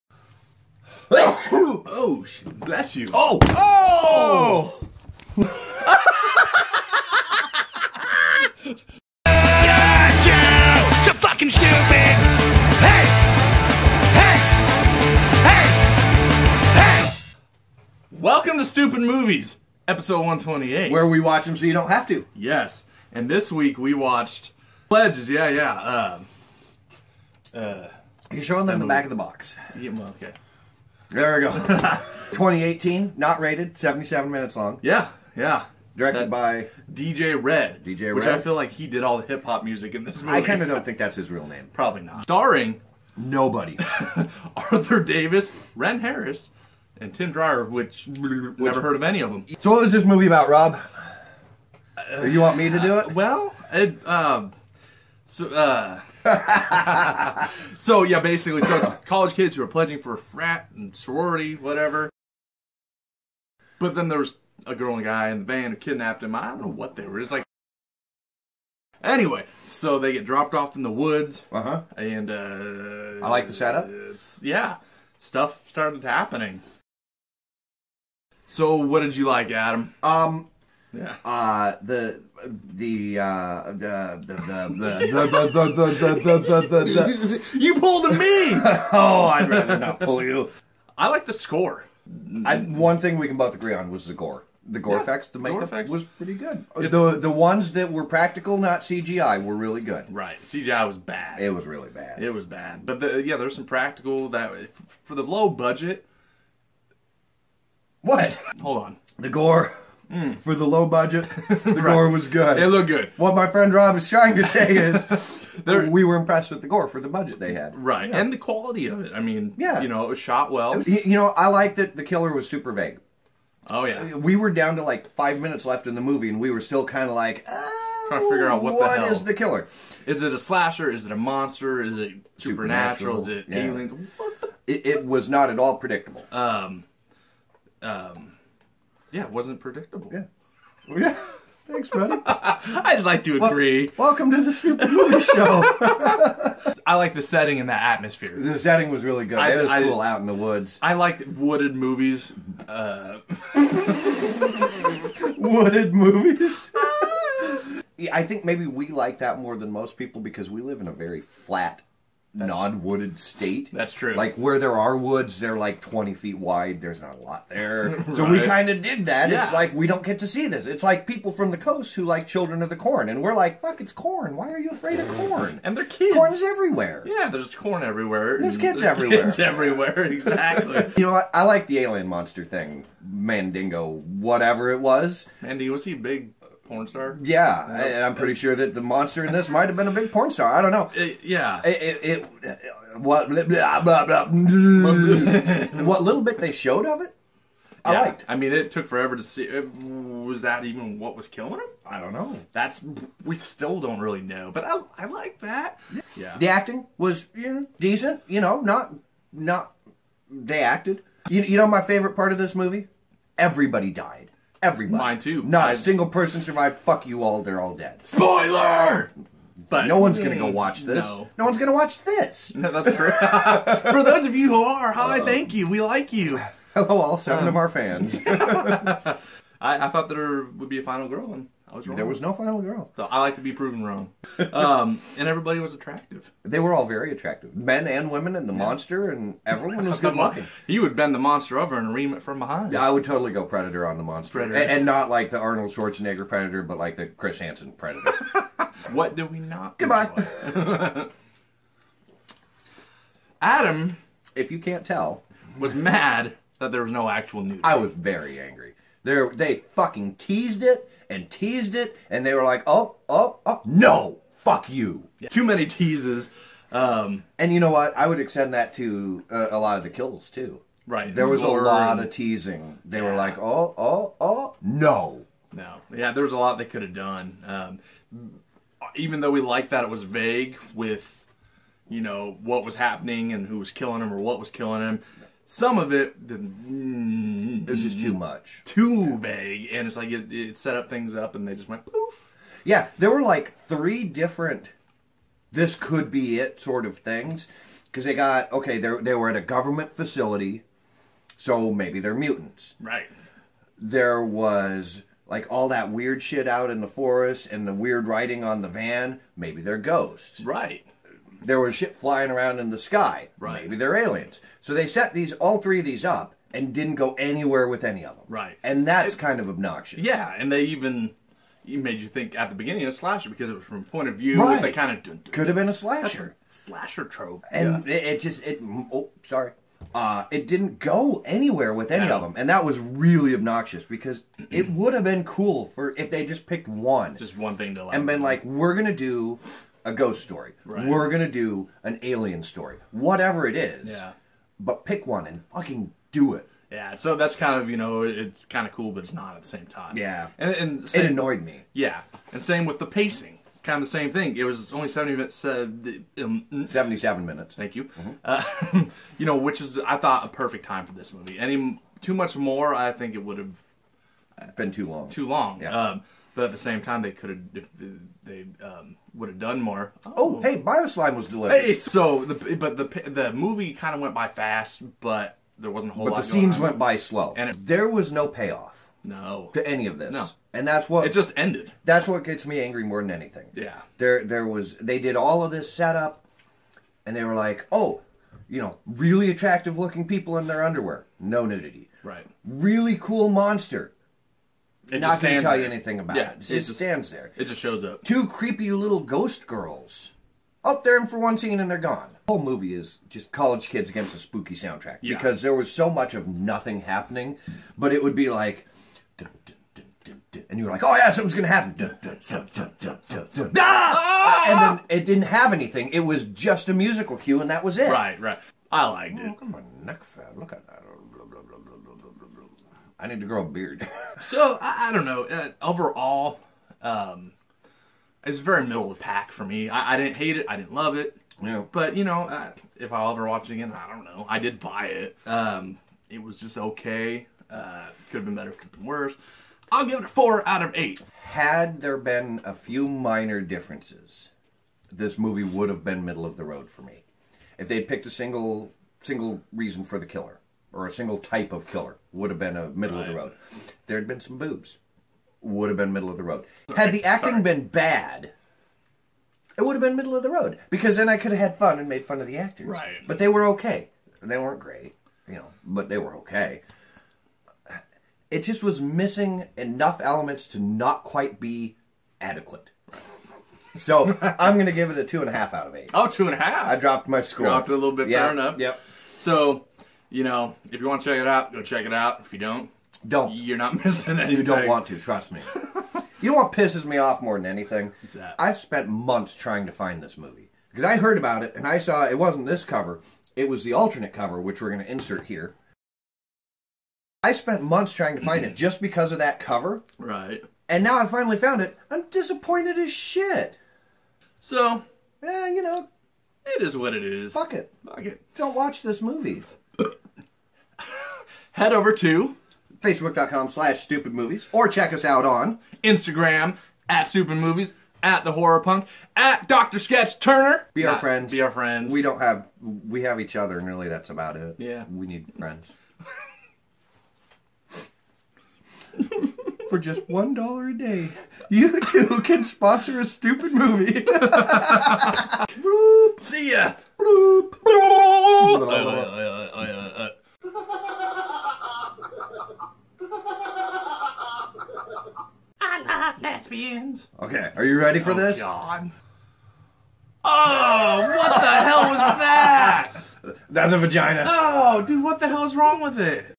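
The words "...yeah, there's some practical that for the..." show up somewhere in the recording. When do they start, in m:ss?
1:43.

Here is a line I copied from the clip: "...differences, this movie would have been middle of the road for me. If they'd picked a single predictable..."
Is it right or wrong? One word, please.
wrong.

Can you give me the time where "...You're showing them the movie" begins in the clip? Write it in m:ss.
0:28.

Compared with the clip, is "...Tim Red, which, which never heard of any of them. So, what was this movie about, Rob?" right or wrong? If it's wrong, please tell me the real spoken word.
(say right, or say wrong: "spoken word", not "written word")
wrong: "Dreyer", not "Red".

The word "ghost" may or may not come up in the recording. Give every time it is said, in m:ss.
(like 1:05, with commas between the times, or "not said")
5:09, 5:39, 6:38.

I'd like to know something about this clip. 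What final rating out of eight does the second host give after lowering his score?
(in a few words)
2.5.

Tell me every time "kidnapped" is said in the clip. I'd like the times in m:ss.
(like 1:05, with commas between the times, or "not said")
1:05.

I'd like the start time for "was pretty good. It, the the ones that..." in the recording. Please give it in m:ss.
1:35.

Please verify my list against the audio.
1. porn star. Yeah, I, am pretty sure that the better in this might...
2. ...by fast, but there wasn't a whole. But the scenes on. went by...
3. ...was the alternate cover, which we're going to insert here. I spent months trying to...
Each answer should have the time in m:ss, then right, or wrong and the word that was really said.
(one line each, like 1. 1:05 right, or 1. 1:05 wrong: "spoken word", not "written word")
1. 3:06 wrong: "monster", not "better"
2. 6:14 right
3. 8:13 right.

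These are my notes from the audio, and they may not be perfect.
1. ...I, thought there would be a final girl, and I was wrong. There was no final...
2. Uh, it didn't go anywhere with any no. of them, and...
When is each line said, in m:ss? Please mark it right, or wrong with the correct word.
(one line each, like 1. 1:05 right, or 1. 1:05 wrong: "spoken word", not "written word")
1. 3:49 right
2. 5:29 right.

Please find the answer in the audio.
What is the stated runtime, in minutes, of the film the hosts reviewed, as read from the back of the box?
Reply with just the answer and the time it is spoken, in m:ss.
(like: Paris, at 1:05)
77, at 0:33.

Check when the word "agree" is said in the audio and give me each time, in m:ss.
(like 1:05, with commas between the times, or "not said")
1:33, 2:23.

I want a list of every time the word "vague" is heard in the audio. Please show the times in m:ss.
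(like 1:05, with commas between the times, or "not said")
2:02, 4:40, 4:49.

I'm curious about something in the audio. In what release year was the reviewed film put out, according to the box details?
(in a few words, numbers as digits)
2018.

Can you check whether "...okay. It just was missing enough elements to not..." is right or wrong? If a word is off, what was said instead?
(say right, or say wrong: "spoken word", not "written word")
right.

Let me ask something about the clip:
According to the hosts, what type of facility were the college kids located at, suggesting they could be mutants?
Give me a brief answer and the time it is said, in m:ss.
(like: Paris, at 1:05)
government facility, at 4:59.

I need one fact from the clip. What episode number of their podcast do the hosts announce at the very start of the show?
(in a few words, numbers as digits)
128.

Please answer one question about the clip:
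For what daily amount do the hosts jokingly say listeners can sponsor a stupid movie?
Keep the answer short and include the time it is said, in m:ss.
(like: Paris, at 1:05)
$1, at 8:50.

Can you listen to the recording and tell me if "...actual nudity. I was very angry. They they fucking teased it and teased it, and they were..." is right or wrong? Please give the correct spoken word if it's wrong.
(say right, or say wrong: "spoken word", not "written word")
right.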